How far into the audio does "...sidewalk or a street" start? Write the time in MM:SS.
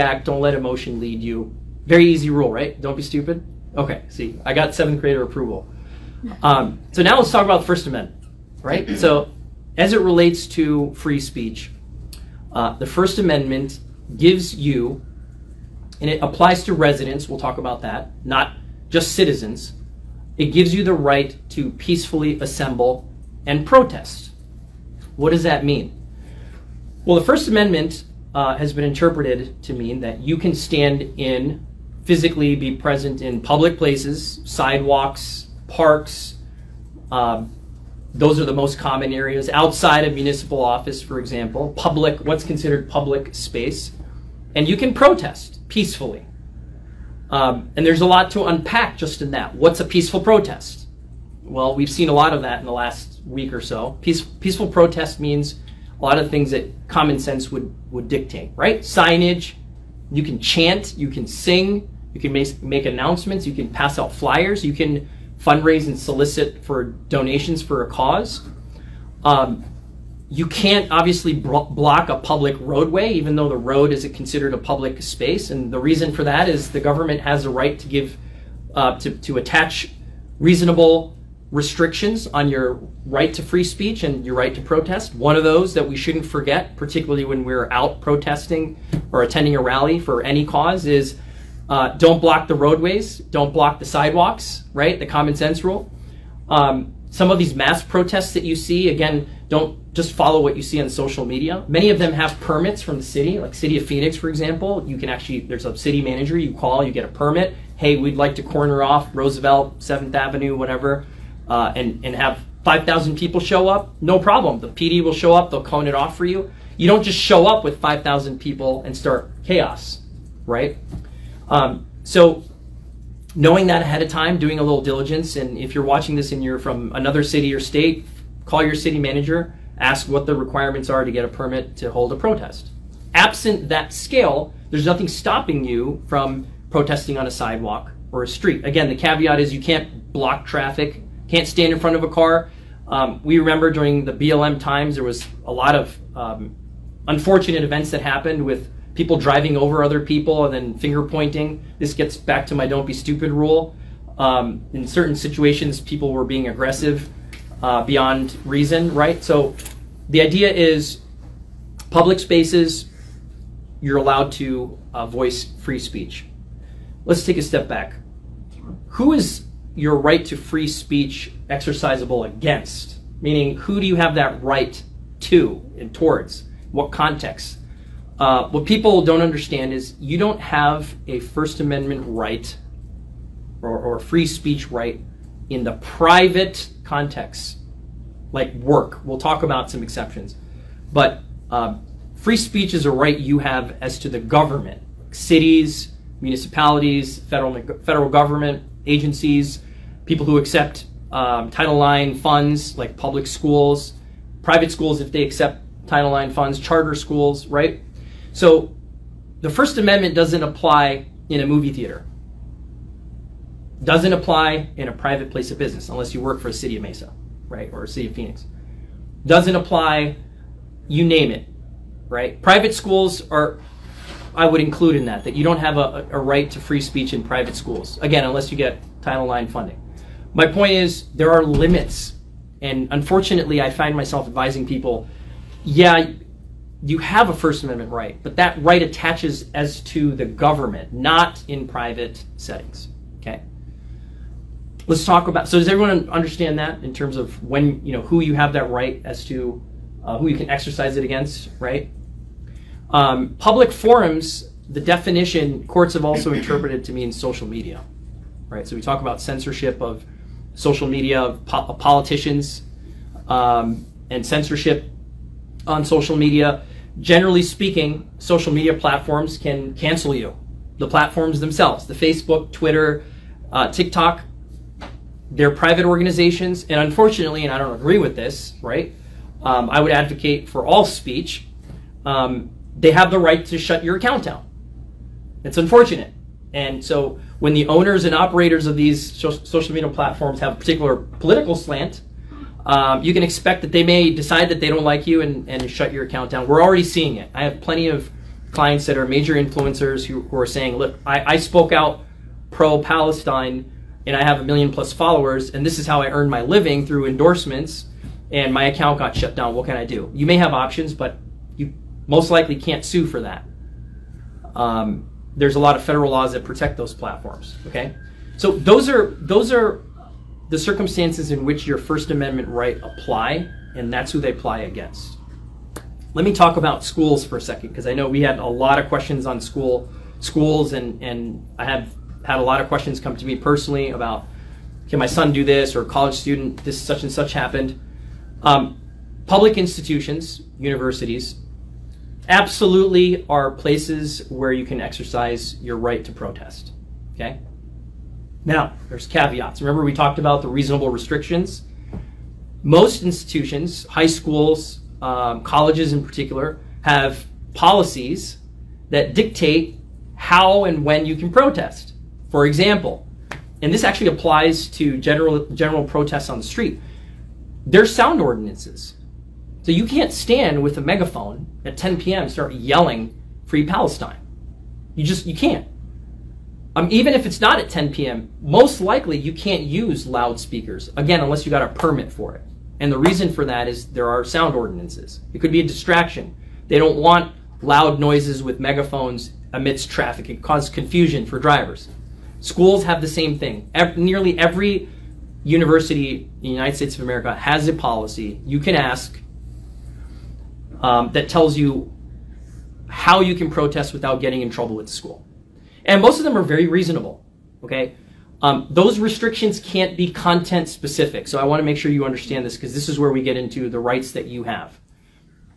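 02:17.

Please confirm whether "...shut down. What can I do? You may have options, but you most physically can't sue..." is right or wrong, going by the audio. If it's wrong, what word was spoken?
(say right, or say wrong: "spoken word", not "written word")
wrong: "likely", not "physically".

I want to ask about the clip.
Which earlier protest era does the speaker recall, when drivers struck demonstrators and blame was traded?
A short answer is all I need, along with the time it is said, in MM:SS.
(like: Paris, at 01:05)
BLM, at 02:24.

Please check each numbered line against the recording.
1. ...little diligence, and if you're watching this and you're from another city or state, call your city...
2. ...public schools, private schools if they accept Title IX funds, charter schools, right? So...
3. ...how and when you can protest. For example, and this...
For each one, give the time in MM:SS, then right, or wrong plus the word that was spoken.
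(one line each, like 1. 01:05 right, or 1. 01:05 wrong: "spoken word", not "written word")
1. 02:04 right
2. 03:22 right
3. 06:00 right.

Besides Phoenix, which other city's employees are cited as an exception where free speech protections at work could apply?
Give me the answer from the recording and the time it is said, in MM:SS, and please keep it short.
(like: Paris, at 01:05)
Mesa, at 03:36.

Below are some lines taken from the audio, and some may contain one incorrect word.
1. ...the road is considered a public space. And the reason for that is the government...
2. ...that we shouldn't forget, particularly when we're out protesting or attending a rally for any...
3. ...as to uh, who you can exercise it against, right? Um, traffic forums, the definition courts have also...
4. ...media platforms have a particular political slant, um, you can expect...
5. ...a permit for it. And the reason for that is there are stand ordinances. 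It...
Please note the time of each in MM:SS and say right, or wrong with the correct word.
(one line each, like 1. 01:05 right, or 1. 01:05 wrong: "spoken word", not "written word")
1. 01:13 right
2. 01:25 right
3. 04:09 wrong: "public", not "traffic"
4. 04:49 right
5. 06:21 wrong: "sound", not "stand".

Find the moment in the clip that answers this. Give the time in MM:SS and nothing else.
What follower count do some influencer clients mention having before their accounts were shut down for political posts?
05:04.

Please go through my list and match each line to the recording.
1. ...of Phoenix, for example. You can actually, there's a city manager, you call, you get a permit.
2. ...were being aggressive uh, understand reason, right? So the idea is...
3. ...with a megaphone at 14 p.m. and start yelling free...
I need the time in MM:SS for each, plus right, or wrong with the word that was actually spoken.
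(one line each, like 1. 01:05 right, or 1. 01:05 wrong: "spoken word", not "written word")
1. 01:43 right
2. 02:36 wrong: "beyond", not "understand"
3. 06:10 wrong: "10", not "14".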